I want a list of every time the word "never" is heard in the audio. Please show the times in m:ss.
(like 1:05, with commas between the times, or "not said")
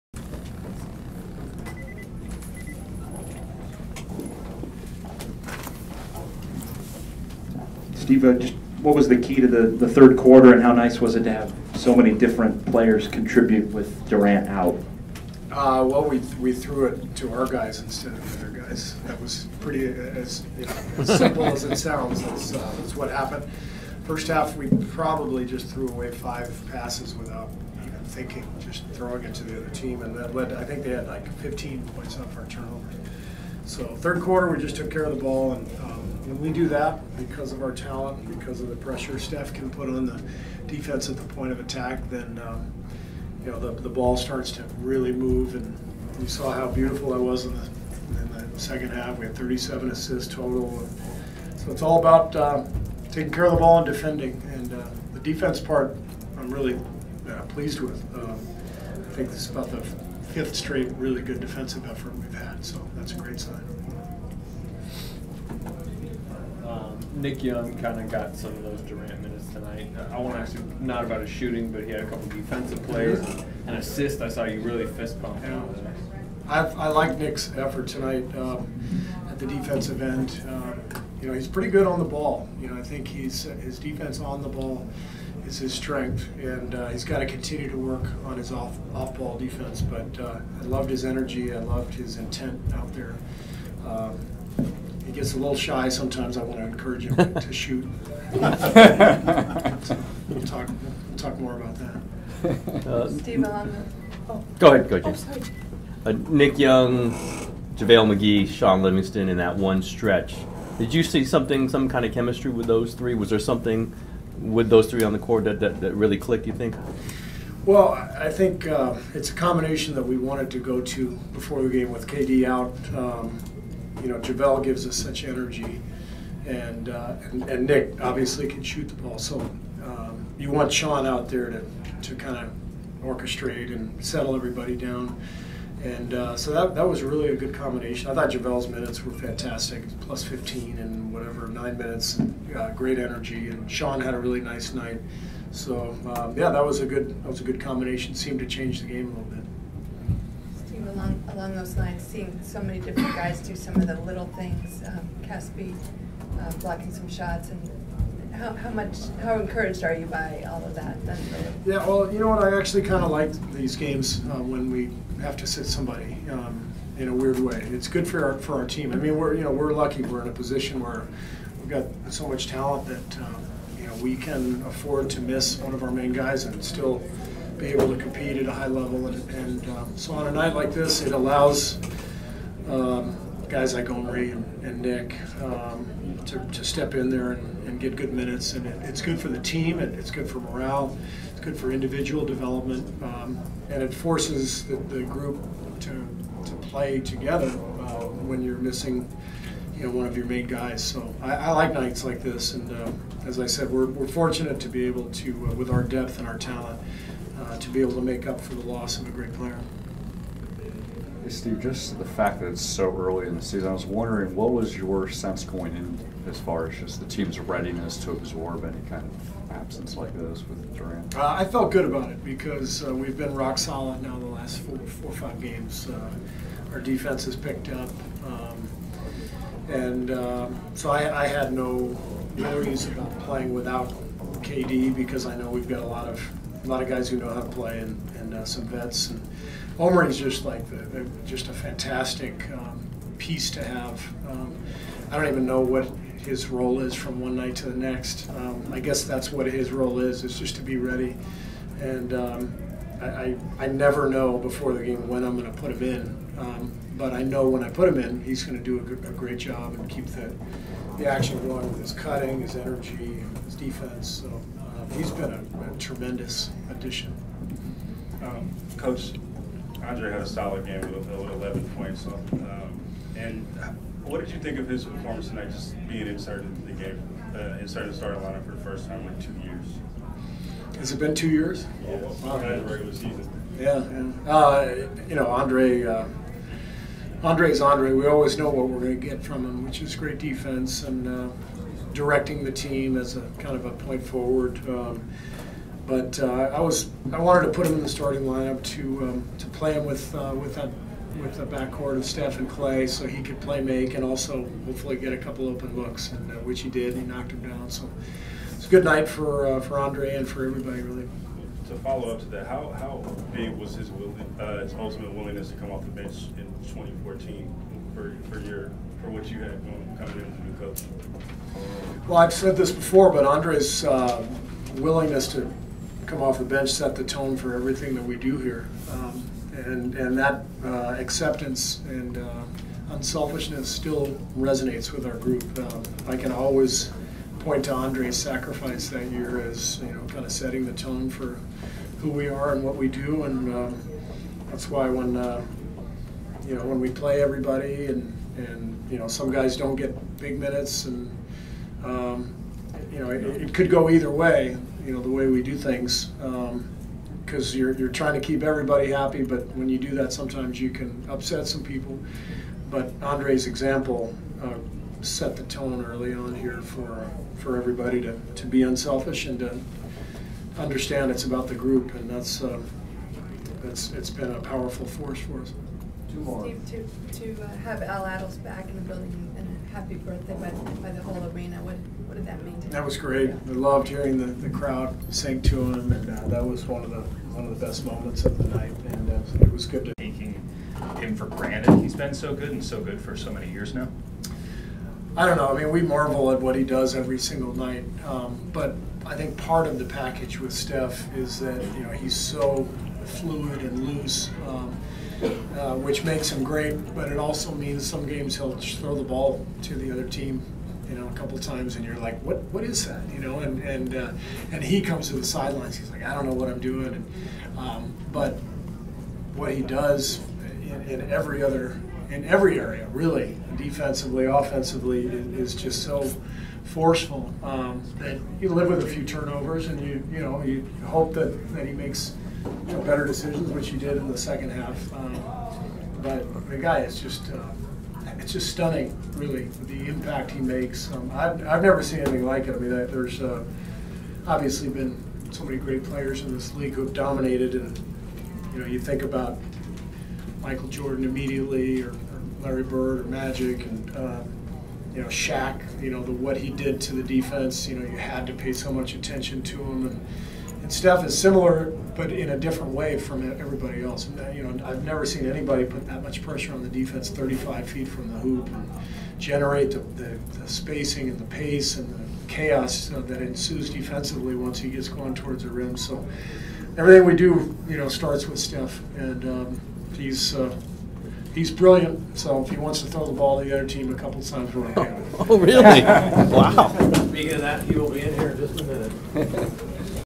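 4:13, 7:21, 7:44.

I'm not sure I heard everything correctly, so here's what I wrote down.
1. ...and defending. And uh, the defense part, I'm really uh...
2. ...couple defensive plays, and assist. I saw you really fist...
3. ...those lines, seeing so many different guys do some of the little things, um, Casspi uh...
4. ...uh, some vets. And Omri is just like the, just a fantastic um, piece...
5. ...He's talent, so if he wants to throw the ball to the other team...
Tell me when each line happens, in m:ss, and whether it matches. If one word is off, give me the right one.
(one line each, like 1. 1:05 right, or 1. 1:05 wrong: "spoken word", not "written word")
1. 0:53 right
2. 1:12 right
3. 2:31 right
4. 3:58 right
5. 8:01 wrong: "brilliant", not "talent".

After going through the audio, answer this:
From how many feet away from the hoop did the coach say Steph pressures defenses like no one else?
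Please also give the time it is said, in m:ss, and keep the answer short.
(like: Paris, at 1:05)
35, at 7:47.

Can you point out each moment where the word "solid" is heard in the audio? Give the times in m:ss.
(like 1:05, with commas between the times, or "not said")
3:43, 4:30.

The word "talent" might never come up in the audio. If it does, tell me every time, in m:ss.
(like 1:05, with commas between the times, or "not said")
0:37, 2:52, 3:26.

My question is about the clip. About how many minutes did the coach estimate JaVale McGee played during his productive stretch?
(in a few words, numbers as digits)
9.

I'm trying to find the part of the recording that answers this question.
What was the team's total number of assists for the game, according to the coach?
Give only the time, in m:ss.
0:49.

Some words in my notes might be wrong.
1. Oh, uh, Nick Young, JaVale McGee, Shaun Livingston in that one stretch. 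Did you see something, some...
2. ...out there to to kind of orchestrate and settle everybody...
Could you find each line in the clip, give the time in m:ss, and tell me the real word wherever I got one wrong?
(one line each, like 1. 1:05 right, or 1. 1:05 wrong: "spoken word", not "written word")
1. 1:46 right
2. 2:11 right.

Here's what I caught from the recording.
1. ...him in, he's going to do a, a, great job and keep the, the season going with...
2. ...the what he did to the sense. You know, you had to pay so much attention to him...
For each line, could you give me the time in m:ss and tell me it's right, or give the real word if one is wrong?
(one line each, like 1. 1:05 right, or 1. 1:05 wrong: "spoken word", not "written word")
1. 4:17 wrong: "action", not "season"
2. 7:36 wrong: "defense", not "sense".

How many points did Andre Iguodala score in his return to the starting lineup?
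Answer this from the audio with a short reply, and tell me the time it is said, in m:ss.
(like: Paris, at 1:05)
11, at 4:31.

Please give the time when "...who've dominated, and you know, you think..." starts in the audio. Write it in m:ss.
7:26.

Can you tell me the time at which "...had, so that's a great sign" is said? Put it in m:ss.
1:02.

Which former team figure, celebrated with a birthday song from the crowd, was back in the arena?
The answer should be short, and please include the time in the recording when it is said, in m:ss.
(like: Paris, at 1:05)
Al Attles, at 6:17.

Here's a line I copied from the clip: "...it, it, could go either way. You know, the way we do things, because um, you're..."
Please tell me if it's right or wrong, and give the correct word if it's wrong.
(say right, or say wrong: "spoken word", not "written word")
right.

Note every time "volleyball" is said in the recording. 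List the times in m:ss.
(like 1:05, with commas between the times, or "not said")
not said.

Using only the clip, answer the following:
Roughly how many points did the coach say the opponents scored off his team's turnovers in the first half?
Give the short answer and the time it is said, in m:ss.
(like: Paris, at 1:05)
15, at 0:31.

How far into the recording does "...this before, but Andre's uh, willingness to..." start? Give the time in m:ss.
5:22.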